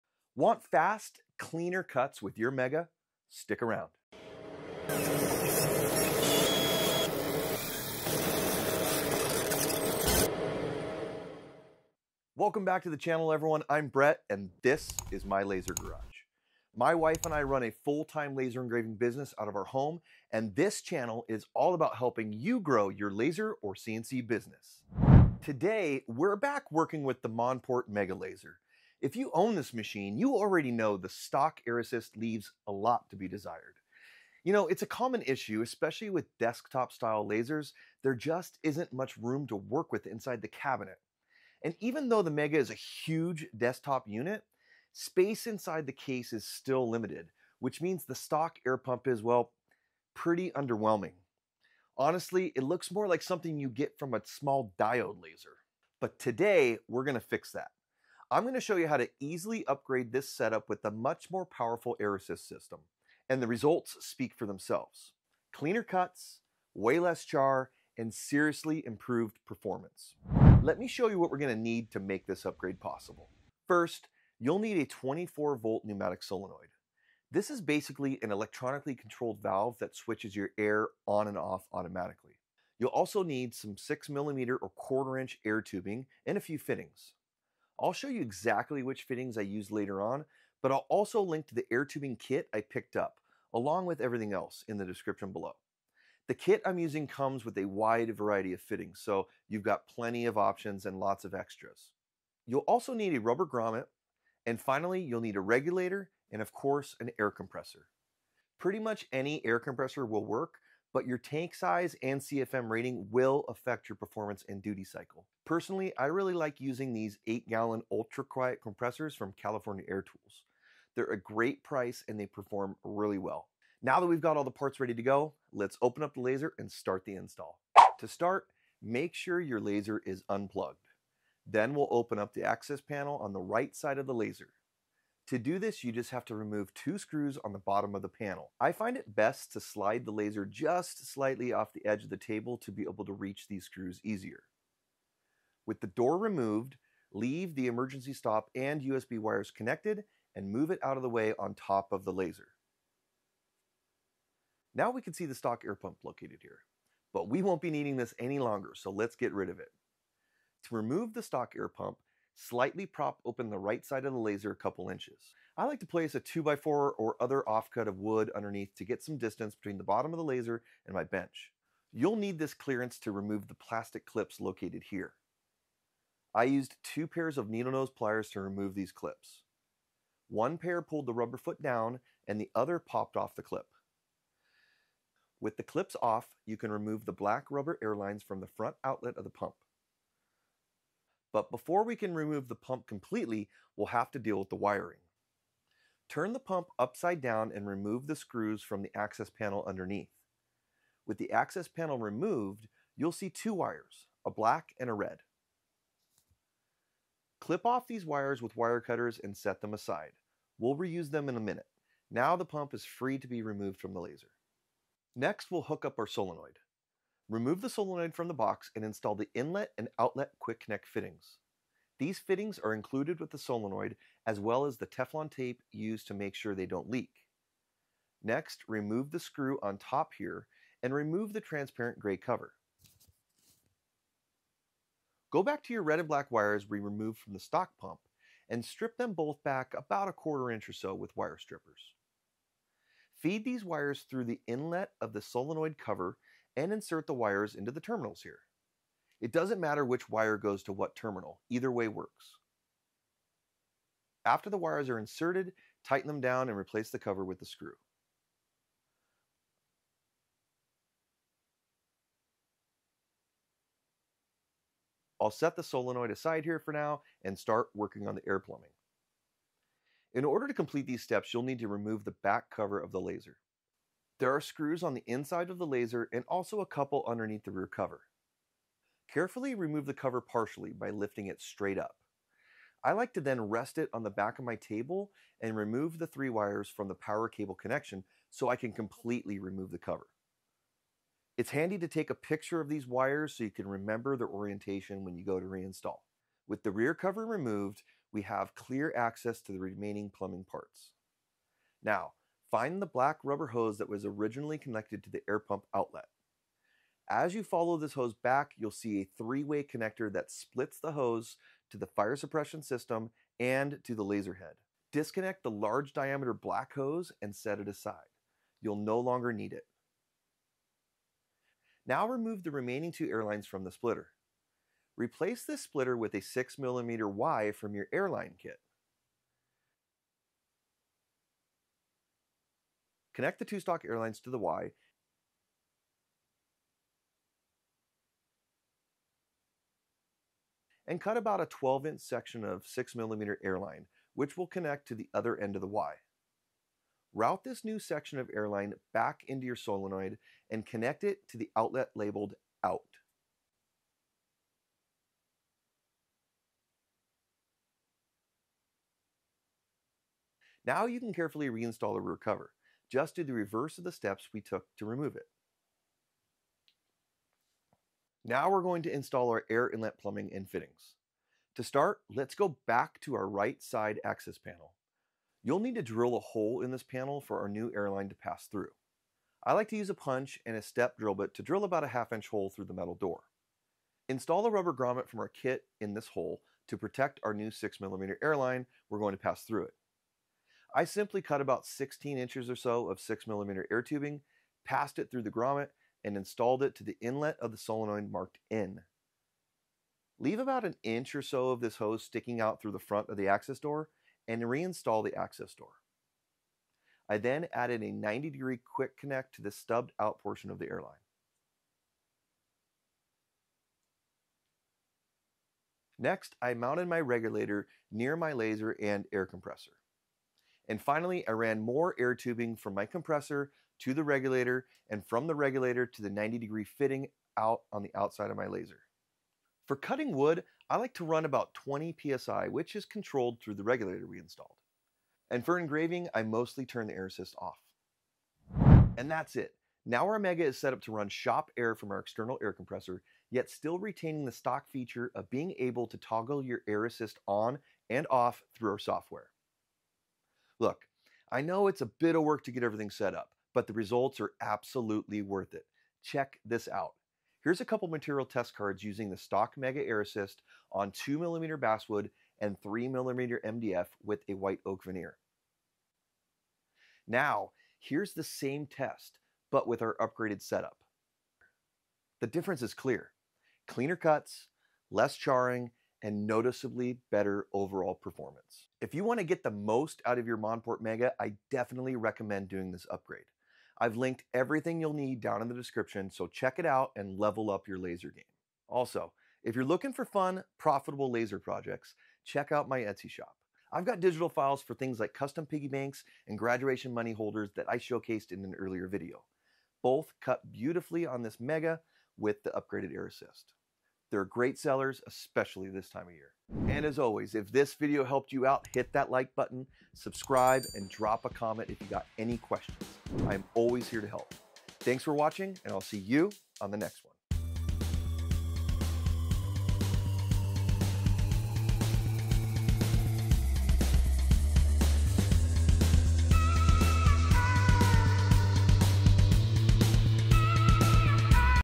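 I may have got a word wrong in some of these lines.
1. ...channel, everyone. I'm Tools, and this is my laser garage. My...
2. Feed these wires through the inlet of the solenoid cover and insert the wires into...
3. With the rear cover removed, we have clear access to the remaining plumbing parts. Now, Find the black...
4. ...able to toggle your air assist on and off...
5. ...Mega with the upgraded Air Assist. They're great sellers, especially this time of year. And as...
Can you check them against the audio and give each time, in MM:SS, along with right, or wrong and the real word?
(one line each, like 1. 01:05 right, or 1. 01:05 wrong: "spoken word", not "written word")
1. 00:12 wrong: "Brett", not "Tools"
2. 04:03 right
3. 04:56 right
4. 07:25 right
5. 08:21 right.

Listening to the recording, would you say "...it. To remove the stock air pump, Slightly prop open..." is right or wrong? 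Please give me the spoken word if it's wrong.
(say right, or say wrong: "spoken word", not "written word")
right.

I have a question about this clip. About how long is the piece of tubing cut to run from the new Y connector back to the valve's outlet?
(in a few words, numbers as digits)
12 inches.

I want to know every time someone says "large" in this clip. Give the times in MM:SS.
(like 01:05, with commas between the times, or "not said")
05:15.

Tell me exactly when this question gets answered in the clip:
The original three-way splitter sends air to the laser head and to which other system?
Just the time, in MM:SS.
05:11.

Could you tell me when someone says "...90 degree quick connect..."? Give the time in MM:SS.
06:47.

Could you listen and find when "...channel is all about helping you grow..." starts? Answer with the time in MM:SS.
00:20.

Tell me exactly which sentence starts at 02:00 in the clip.
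They're a great price and they perform really well.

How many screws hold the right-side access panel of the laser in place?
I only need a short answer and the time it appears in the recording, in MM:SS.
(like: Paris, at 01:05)
2, at 02:16.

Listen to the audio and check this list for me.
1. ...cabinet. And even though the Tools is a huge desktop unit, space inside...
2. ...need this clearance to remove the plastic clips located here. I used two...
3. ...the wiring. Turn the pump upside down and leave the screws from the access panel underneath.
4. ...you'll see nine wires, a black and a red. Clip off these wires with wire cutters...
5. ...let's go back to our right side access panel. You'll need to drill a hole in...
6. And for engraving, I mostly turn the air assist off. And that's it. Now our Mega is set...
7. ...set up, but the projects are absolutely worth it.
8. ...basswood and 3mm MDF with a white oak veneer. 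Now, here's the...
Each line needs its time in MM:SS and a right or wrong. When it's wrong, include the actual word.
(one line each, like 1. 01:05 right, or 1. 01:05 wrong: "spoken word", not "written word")
1. 00:40 wrong: "Mega", not "Tools"
2. 02:52 right
3. 03:14 wrong: "remove", not "leave"
4. 03:22 wrong: "two", not "nine"
5. 06:12 right
6. 07:15 right
7. 07:32 wrong: "results", not "projects"
8. 07:41 right.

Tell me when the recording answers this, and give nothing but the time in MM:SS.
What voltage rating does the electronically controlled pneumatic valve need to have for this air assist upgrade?
01:14.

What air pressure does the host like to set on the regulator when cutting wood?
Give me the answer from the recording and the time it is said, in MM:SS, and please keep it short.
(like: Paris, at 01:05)
20 PSI, at 07:11.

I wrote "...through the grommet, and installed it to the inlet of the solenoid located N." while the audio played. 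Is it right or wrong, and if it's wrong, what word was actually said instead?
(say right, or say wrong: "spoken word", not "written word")
wrong: "marked", not "located".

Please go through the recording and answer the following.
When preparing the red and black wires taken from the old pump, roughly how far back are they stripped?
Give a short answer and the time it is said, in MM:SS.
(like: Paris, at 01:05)
a quarter inch, at 04:00.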